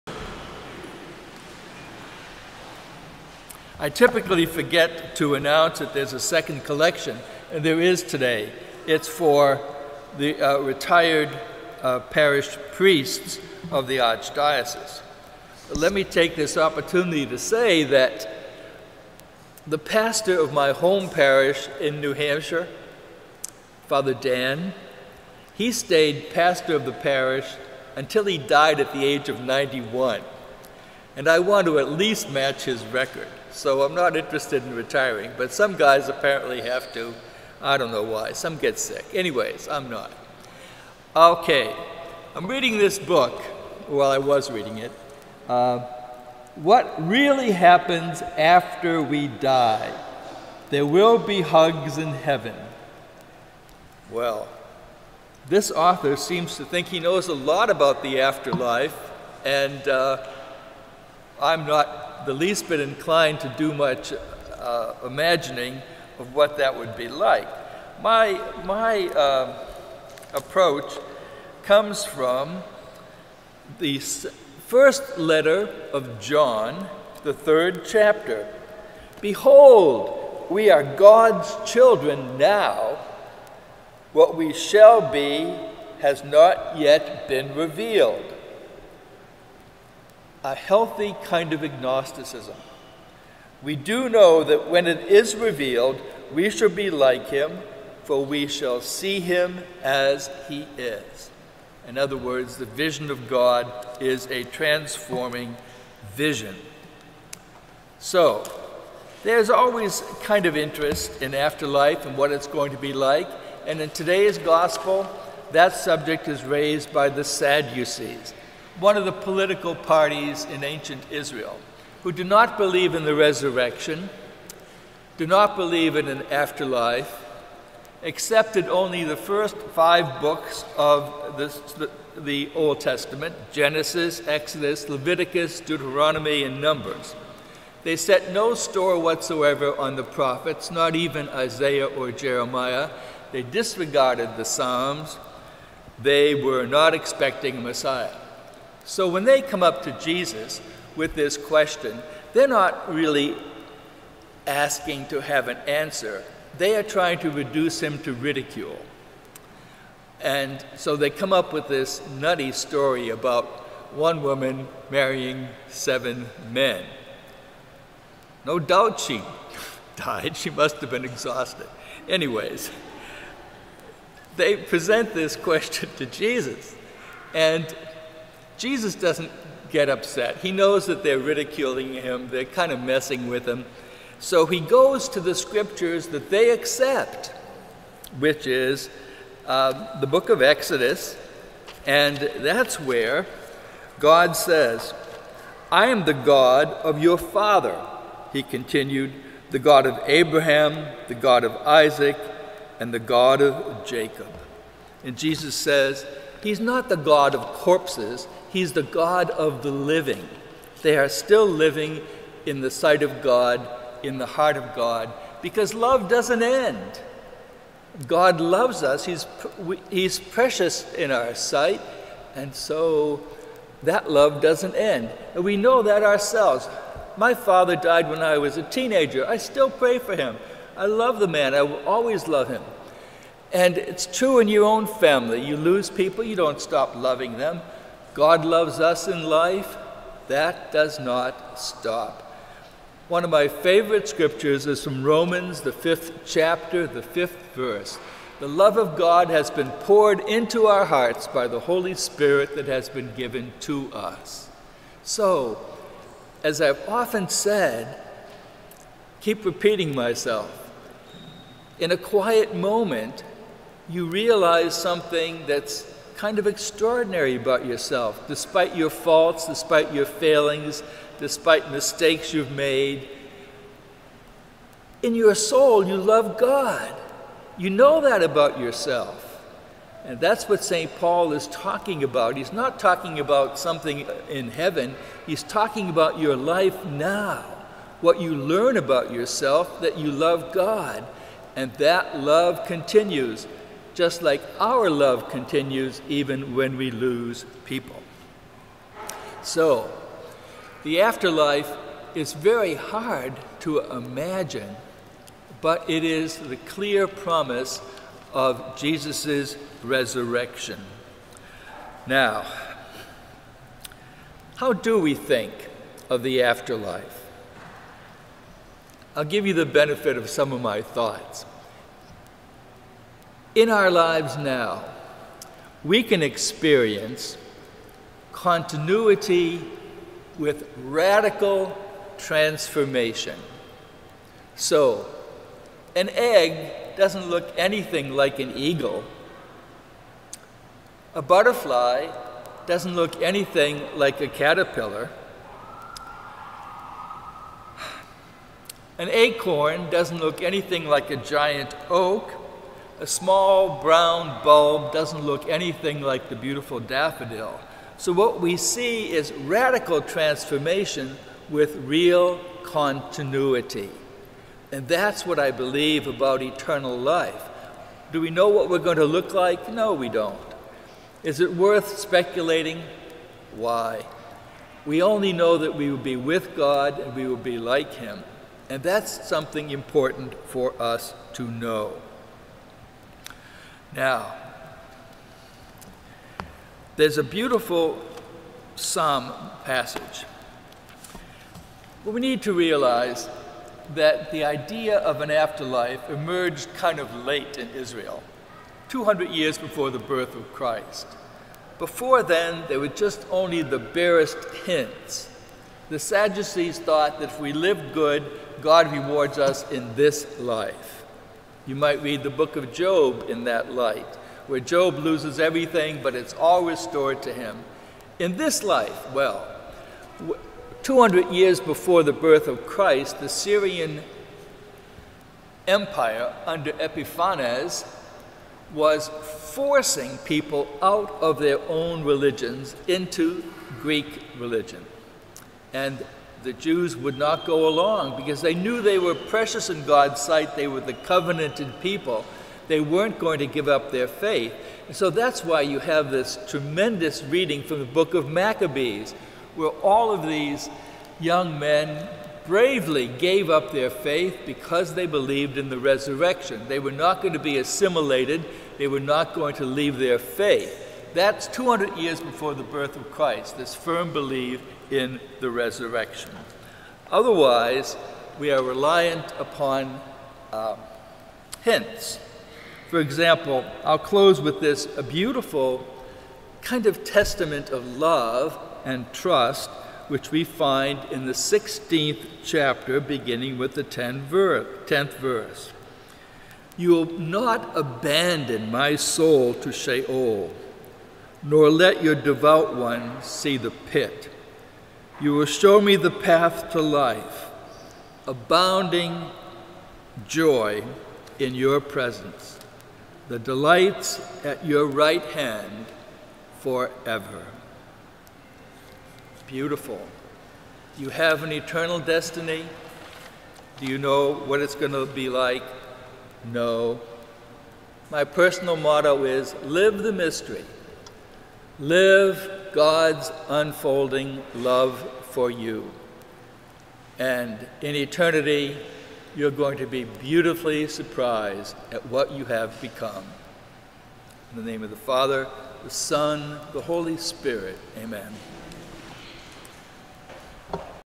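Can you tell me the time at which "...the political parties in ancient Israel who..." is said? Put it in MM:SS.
01:59.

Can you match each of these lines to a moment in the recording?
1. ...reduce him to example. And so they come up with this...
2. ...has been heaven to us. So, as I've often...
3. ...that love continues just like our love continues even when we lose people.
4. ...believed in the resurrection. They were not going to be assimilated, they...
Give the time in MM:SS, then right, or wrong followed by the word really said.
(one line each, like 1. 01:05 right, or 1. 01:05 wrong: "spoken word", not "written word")
1. 02:37 wrong: "ridicule", not "example"
2. 04:12 wrong: "given", not "heaven"
3. 04:51 right
4. 07:35 right.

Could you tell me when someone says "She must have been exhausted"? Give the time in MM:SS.
02:50.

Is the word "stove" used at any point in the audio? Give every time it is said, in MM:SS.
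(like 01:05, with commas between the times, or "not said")
not said.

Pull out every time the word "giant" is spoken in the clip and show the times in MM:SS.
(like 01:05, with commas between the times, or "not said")
05:51.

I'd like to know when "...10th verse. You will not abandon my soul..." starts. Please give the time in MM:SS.
08:03.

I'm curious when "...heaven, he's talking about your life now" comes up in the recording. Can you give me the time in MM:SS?
04:44.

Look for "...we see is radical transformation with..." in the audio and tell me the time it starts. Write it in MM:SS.
05:58.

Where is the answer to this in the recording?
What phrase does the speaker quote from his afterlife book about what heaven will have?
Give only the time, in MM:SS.
00:51.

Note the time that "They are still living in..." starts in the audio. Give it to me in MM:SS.
03:30.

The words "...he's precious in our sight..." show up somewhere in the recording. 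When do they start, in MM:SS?
03:39.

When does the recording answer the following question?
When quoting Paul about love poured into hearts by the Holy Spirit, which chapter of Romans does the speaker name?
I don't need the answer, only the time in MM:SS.
04:05.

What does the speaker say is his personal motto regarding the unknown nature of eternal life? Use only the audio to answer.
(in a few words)
Live the mystery.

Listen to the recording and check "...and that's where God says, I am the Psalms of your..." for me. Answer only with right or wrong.
wrong.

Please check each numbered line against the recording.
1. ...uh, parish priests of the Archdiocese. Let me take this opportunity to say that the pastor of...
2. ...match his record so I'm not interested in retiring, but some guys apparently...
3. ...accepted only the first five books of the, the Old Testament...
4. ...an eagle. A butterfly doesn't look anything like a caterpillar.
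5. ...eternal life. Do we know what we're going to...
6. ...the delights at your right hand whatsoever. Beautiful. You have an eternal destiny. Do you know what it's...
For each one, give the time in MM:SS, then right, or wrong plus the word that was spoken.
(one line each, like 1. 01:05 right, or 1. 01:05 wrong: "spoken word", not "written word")
1. 00:11 right
2. 00:32 right
3. 02:08 right
4. 05:38 right
5. 06:06 right
6. 08:23 wrong: "forever", not "whatsoever".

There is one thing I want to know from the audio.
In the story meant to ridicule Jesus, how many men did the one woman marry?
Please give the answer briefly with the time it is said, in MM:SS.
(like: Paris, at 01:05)
7, at 02:45.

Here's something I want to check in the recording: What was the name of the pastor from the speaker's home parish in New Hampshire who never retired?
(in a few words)
Father Dan.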